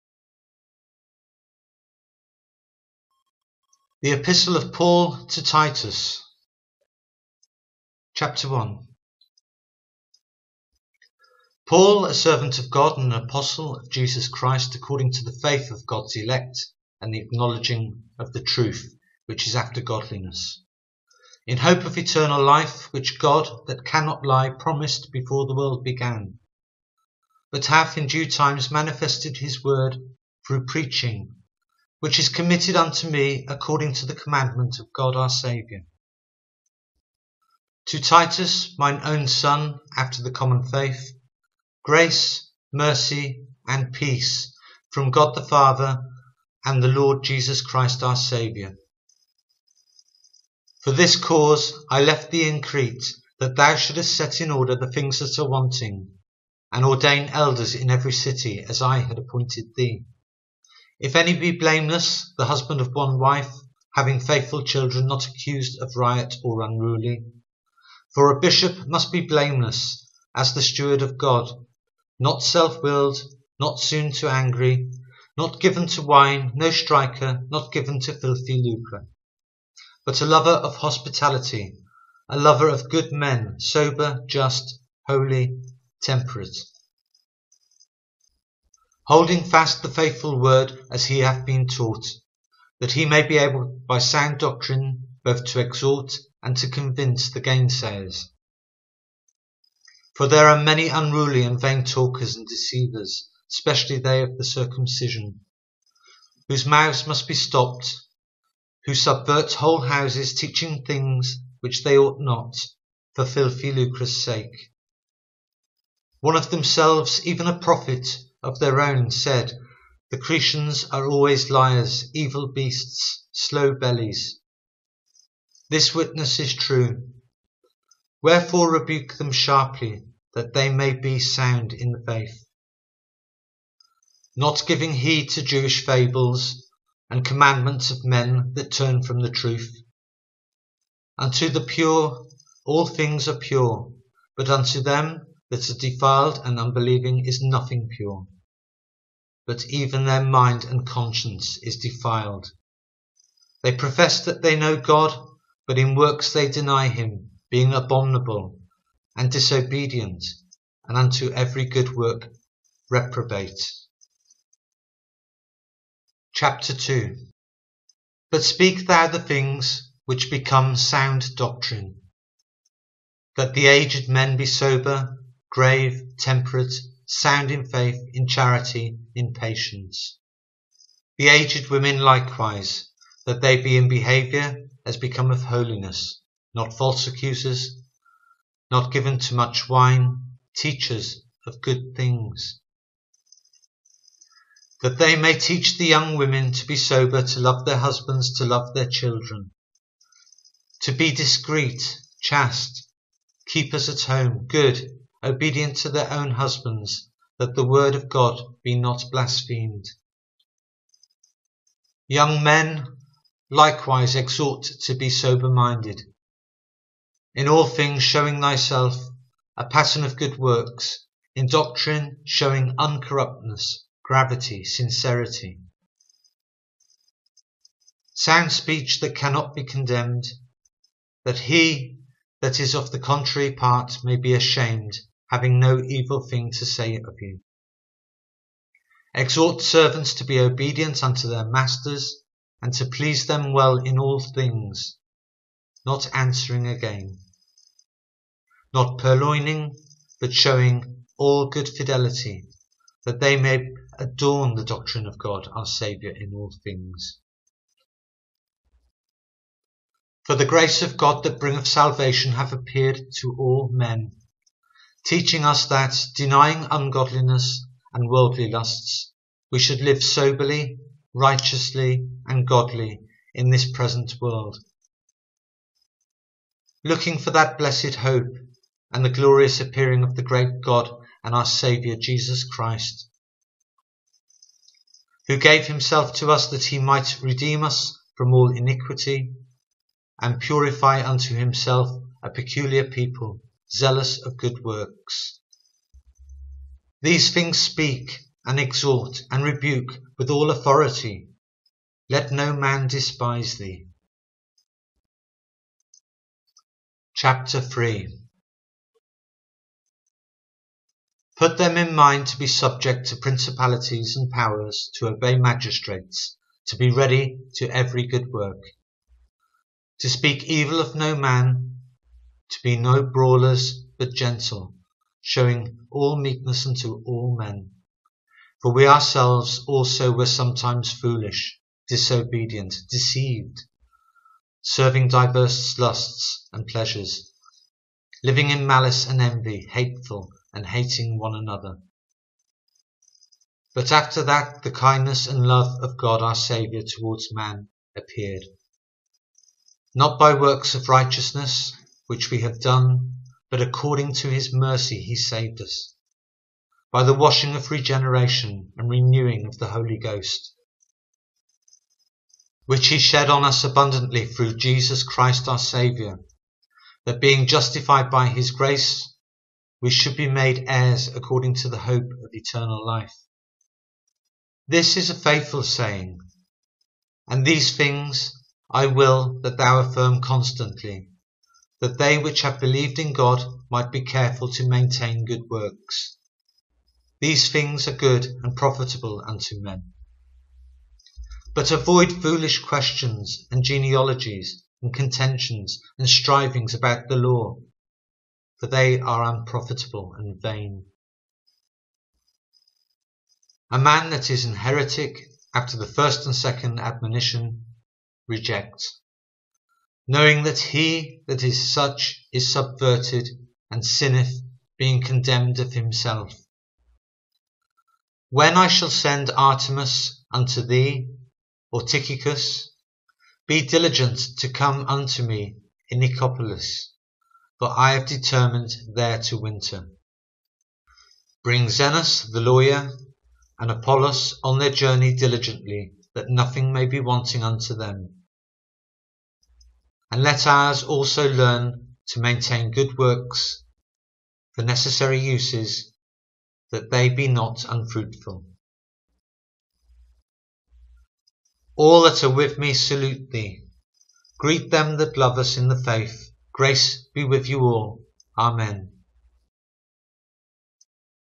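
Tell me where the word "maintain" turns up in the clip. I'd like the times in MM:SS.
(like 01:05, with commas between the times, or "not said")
06:24, 07:22.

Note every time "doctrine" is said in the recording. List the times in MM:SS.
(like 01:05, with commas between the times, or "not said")
01:34, 02:51, 03:41, 04:14.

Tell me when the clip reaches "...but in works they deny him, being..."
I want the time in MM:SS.
02:35.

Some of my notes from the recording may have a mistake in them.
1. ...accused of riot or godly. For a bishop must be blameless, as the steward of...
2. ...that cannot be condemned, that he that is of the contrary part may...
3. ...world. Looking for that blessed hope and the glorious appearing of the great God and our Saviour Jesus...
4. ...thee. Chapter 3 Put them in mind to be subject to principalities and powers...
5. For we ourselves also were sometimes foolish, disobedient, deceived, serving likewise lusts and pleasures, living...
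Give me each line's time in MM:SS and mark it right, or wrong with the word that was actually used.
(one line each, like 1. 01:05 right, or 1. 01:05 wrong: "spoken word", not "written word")
1. 01:05 wrong: "unruly", not "godly"
2. 03:49 right
3. 04:34 right
4. 05:03 right
5. 05:28 wrong: "diverse", not "likewise".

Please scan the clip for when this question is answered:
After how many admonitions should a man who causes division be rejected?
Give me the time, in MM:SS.
06:45.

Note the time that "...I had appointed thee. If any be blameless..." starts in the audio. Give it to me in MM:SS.
00:58.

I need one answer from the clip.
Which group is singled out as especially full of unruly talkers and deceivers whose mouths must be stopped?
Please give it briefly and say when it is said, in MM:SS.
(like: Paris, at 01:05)
they of the circumcision, at 01:43.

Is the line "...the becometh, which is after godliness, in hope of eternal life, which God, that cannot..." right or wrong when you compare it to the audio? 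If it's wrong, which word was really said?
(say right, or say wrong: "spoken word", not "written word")
wrong: "truth", not "becometh".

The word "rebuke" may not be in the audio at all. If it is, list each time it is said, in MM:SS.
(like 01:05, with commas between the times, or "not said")
02:08, 04:59.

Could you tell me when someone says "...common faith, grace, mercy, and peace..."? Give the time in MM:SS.
00:40.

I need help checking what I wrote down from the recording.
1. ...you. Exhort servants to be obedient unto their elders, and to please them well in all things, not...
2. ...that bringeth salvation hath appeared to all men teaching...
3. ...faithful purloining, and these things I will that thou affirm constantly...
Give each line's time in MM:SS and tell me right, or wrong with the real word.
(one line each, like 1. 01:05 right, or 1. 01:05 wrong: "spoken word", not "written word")
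1. 03:57 wrong: "masters", not "elders"
2. 04:21 right
3. 06:15 wrong: "saying", not "purloining".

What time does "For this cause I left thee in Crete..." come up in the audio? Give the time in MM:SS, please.
00:50.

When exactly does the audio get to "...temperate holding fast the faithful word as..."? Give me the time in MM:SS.
01:26.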